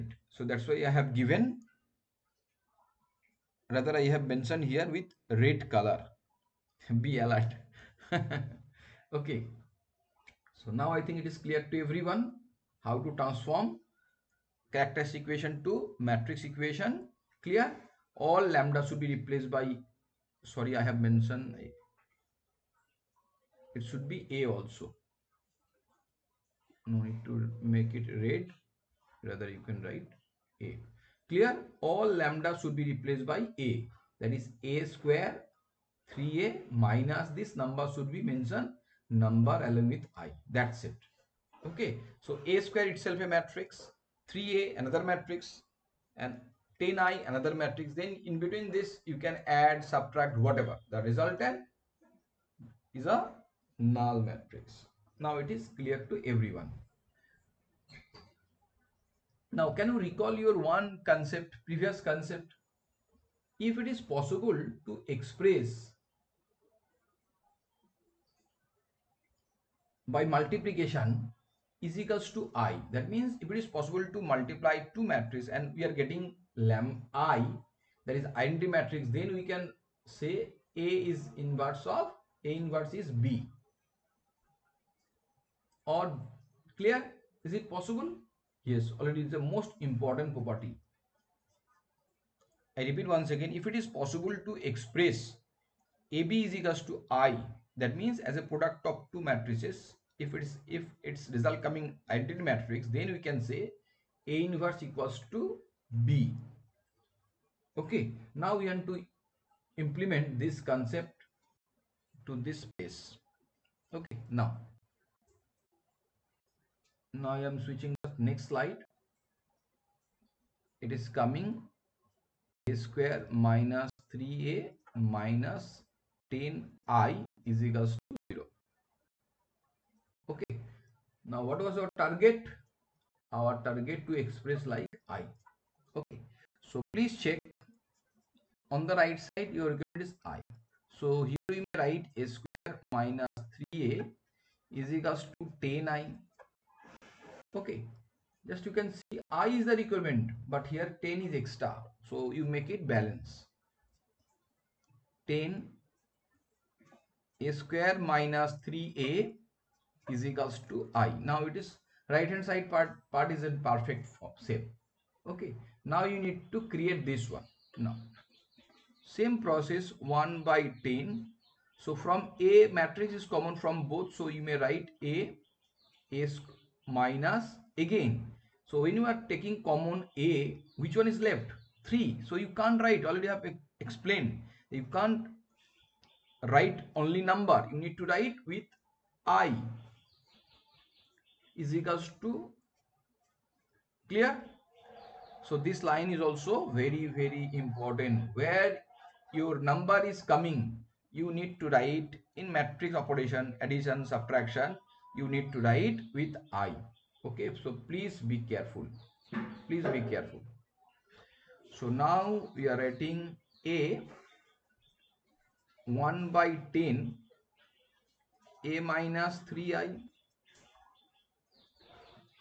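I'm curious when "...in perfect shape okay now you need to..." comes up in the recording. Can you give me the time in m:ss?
2:43.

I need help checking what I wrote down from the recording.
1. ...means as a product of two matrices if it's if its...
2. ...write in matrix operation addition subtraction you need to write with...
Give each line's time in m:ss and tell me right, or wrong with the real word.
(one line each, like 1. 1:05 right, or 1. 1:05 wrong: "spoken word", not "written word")
1. 1:38 right
2. 3:21 right.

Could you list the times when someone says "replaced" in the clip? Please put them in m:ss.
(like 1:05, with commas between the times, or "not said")
0:19, 0:32.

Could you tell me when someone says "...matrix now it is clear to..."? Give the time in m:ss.
0:54.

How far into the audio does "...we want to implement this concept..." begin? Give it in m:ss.
1:48.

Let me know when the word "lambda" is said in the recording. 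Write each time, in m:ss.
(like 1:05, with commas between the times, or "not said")
0:18, 0:32, 1:16.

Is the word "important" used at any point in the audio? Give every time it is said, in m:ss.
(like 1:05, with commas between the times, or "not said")
1:29, 3:17.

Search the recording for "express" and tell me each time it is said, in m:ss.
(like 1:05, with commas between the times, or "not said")
1:05, 1:34, 2:14.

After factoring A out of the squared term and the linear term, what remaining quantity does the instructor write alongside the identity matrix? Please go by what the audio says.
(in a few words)
3I.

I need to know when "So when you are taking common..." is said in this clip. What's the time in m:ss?
2:58.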